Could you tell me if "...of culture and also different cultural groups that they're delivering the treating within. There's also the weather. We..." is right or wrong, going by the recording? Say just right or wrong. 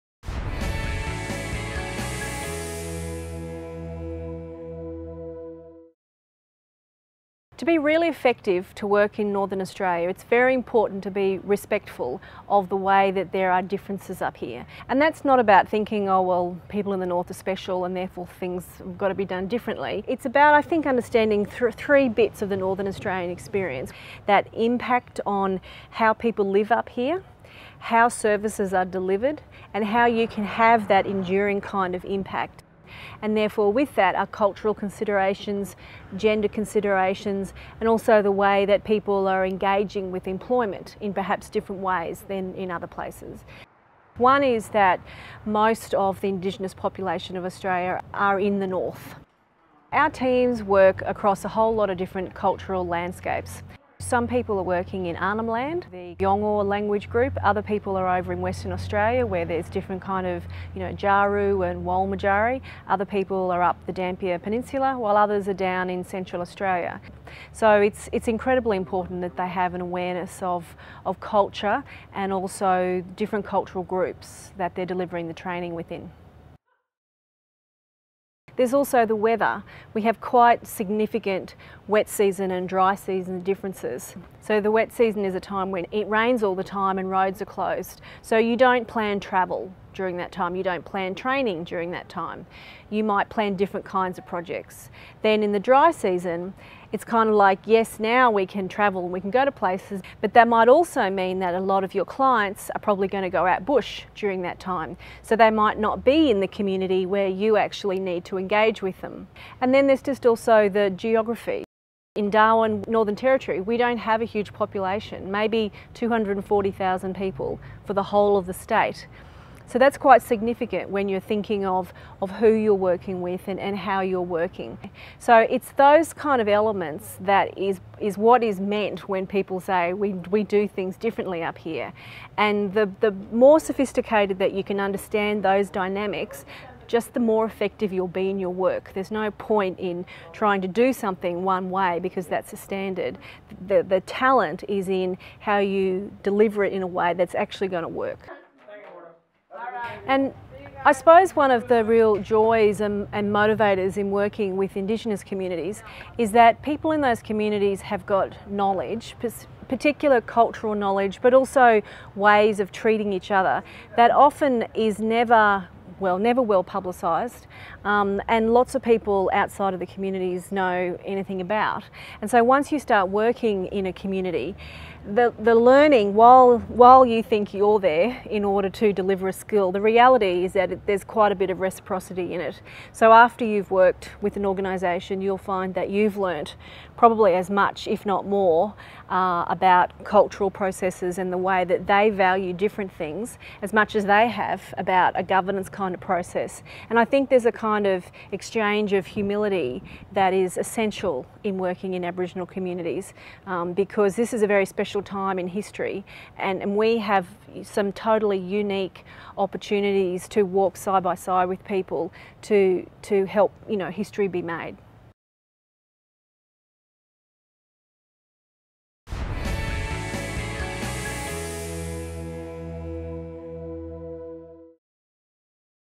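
wrong.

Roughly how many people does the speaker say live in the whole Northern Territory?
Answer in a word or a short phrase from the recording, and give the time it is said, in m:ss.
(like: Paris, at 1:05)
240,000, at 1:55.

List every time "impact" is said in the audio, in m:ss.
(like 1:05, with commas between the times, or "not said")
0:24, 0:32.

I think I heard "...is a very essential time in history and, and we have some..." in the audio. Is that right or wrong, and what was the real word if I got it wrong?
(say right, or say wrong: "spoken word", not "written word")
wrong: "special", not "essential".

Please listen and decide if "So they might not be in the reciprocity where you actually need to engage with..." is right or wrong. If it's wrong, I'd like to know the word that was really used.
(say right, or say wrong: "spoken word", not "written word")
wrong: "community", not "reciprocity".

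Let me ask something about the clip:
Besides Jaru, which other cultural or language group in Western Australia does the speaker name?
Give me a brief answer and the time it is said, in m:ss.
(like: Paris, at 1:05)
Walmajari, at 1:01.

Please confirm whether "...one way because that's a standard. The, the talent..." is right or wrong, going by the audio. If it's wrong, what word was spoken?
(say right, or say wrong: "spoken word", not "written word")
right.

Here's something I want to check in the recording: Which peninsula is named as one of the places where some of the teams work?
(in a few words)
Dampier Peninsula.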